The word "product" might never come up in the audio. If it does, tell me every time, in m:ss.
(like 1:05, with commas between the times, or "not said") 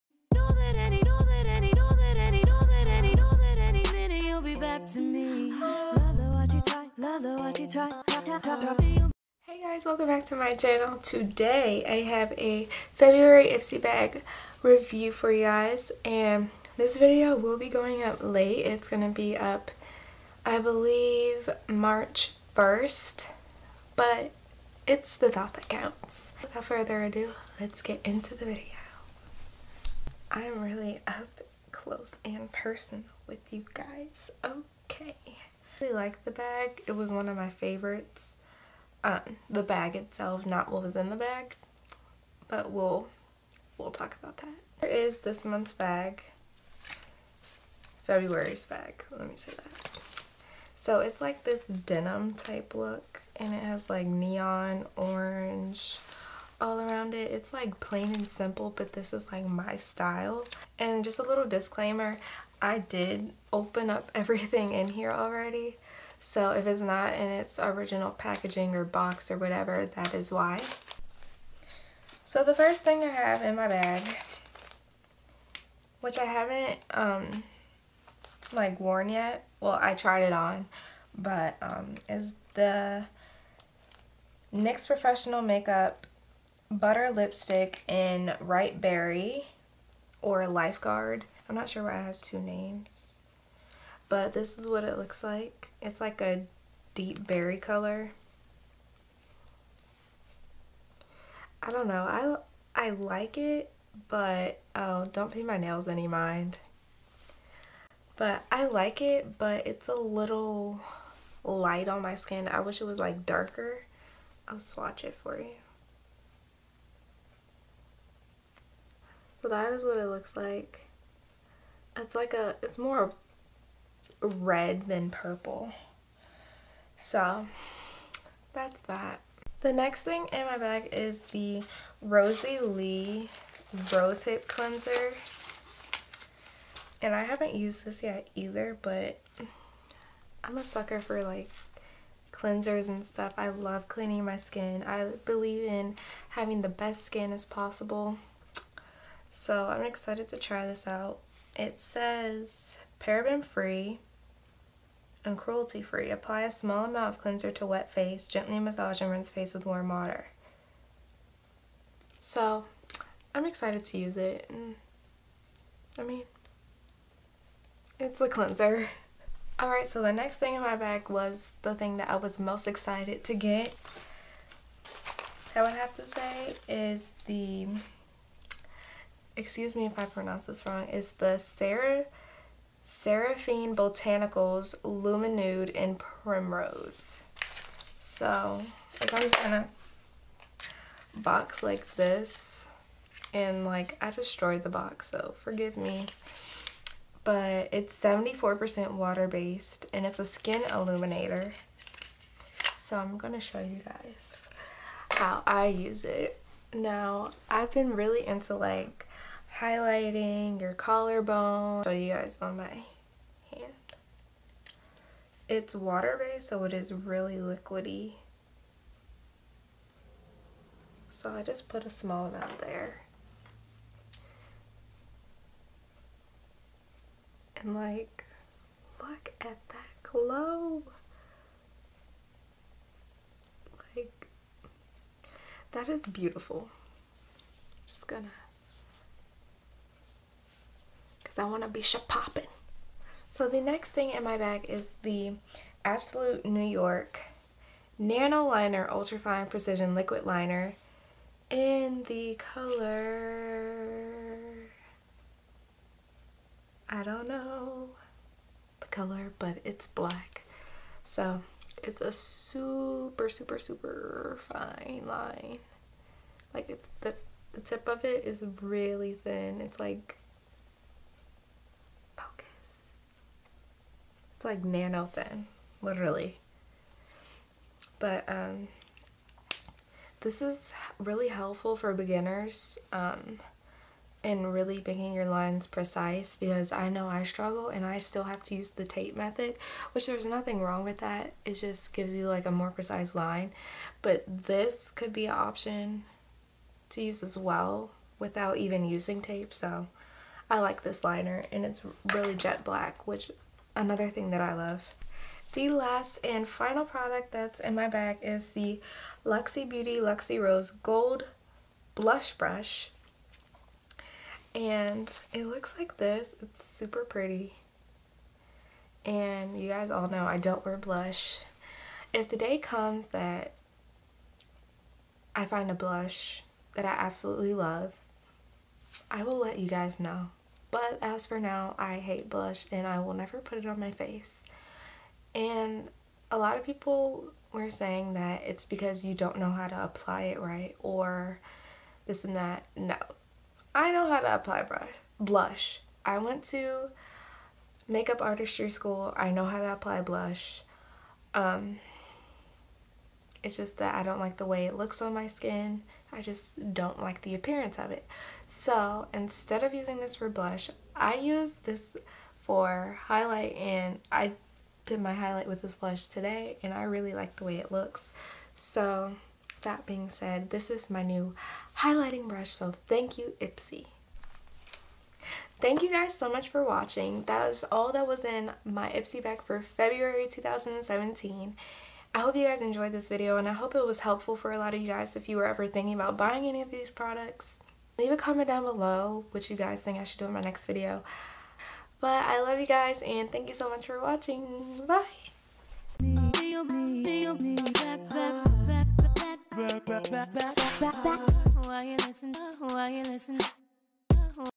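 5:06, 6:26.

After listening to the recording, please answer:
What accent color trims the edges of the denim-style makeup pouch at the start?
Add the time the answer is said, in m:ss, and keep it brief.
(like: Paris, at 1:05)
Neon orange, at 0:54.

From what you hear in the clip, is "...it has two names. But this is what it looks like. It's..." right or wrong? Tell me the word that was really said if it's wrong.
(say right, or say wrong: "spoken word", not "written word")
right.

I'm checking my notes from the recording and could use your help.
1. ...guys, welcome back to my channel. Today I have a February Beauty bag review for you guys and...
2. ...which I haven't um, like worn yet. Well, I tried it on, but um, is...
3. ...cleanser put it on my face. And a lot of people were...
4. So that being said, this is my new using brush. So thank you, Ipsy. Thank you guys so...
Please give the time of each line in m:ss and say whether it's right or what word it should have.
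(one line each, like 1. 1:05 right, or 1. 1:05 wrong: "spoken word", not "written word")
1. 0:09 wrong: "Ipsy", not "Beauty"
2. 1:16 right
3. 5:33 wrong: "never", not "cleanser"
4. 6:08 wrong: "highlighting", not "using".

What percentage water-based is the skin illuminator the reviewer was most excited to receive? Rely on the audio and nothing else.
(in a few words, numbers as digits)
74%.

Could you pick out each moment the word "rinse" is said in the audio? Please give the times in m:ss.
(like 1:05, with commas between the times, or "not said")
2:39.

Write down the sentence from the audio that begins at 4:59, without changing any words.
So I like this liner and it's really jet black, which another thing that I love.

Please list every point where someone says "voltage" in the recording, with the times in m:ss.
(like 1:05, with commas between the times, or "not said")
not said.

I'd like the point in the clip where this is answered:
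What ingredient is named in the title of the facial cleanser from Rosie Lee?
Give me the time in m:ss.
2:13.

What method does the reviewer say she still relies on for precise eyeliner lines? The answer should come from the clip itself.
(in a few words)
Tape method.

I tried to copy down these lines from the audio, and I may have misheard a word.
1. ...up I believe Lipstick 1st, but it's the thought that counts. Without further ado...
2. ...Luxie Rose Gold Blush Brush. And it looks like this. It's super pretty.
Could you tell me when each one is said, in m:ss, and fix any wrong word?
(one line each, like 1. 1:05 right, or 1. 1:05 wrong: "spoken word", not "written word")
1. 0:19 wrong: "March", not "Lipstick"
2. 5:09 right.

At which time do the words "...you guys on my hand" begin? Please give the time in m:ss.
3:31.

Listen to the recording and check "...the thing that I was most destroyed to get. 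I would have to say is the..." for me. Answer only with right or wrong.
wrong.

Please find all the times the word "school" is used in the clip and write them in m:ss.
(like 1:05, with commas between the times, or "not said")
5:48.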